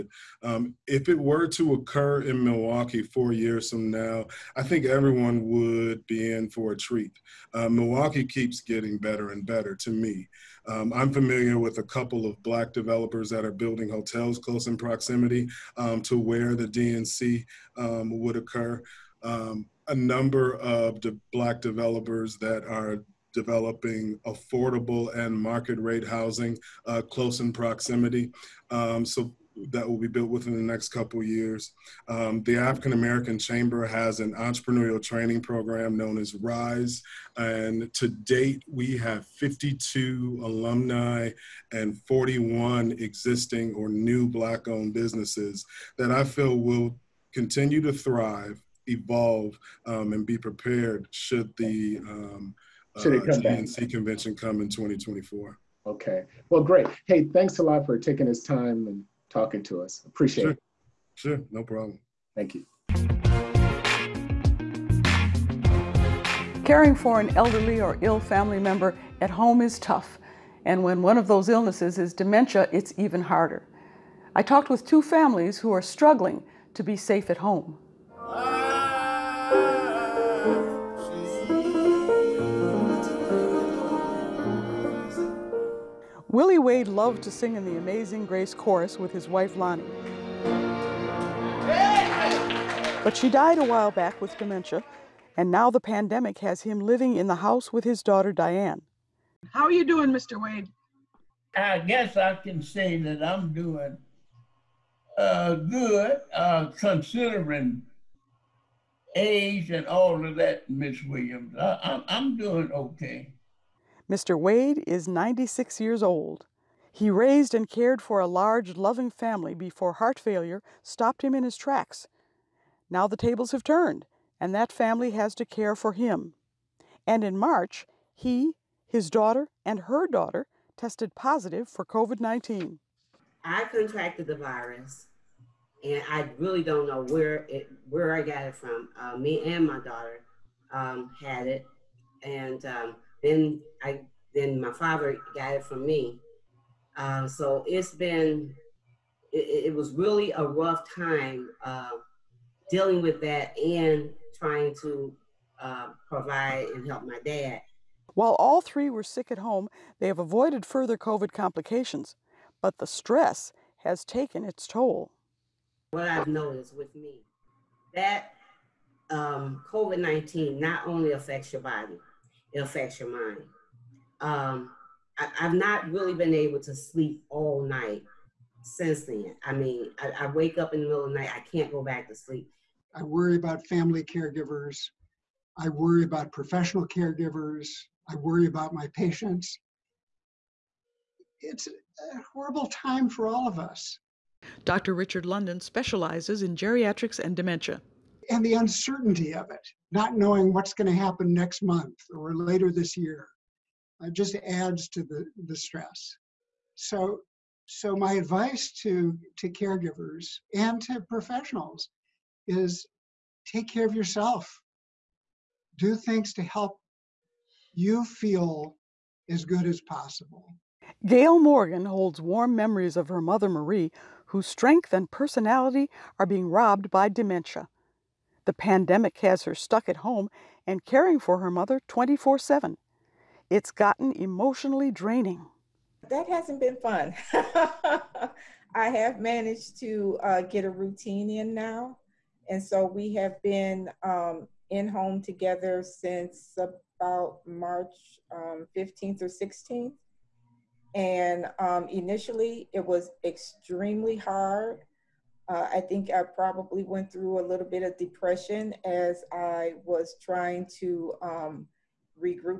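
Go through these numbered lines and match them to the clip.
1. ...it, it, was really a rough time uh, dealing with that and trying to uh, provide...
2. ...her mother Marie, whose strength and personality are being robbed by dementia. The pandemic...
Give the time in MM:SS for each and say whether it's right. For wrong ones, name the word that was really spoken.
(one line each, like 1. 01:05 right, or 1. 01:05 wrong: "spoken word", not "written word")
1. 02:29 right
2. 03:43 right.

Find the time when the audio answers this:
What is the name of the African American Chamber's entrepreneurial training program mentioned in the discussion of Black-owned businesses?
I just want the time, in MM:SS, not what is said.
00:36.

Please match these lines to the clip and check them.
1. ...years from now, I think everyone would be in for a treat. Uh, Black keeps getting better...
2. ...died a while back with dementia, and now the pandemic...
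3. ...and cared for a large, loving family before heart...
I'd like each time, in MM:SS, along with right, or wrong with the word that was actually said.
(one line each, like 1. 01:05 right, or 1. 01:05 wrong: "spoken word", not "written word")
1. 00:03 wrong: "Milwaukee", not "Black"
2. 01:33 right
3. 01:57 right.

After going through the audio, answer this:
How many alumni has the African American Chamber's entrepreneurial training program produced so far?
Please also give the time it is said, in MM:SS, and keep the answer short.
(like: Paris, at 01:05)
52, at 00:39.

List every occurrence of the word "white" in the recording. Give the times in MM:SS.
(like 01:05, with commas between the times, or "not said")
not said.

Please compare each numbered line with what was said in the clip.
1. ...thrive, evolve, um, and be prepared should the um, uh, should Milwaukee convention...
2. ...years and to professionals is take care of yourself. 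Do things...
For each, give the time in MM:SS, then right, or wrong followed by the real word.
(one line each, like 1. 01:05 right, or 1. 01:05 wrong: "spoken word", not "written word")
1. 00:47 wrong: "DNC", not "Milwaukee"
2. 03:29 wrong: "caregivers", not "years".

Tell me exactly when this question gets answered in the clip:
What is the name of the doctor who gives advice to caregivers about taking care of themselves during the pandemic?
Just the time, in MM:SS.
03:14.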